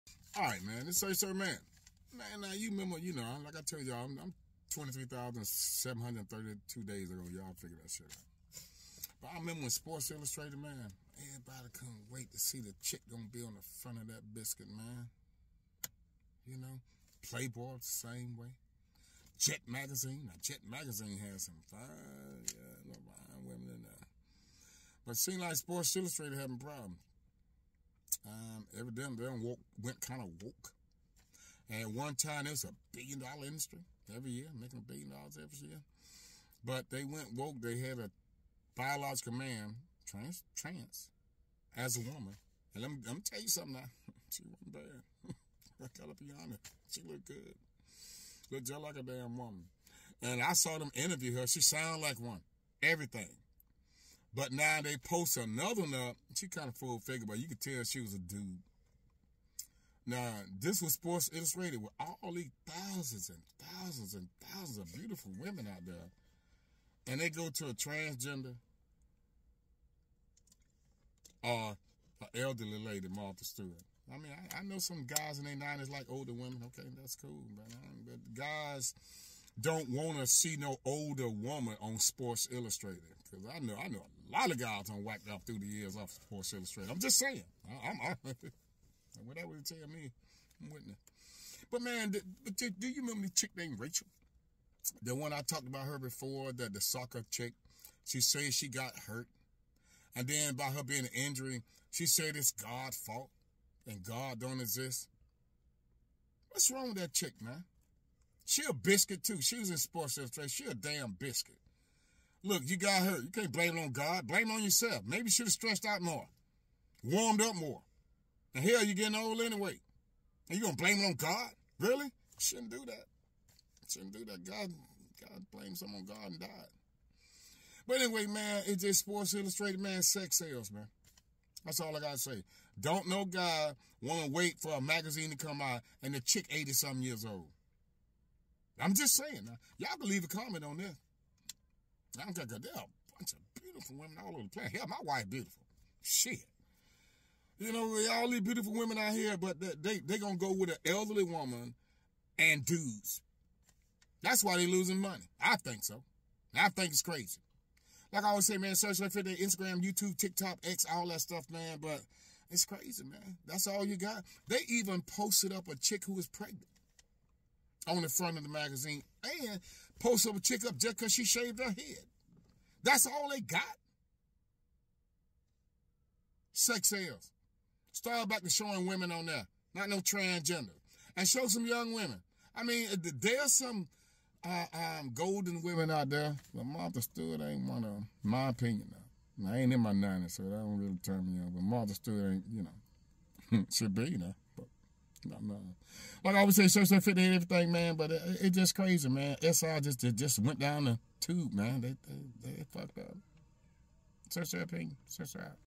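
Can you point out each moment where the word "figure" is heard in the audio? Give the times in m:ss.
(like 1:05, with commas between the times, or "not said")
0:07, 0:56.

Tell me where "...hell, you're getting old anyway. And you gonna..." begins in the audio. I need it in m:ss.
1:58.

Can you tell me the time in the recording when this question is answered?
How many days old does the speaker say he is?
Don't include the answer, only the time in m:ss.
0:04.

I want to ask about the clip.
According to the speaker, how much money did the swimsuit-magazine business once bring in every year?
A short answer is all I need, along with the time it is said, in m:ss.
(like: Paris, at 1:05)
a billion dollars, at 0:34.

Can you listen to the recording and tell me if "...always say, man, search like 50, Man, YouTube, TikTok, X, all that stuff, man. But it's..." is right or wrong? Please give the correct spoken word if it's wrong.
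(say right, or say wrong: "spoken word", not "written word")
wrong: "Instagram", not "Man".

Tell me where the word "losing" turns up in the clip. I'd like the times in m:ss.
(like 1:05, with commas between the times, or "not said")
2:34.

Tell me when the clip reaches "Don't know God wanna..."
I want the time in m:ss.
2:12.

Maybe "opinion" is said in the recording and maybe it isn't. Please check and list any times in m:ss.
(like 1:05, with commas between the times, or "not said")
3:08, 3:24.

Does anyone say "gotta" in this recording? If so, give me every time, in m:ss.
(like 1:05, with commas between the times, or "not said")
0:45, 2:12.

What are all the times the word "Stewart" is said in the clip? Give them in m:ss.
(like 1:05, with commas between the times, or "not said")
1:13, 3:07, 3:11.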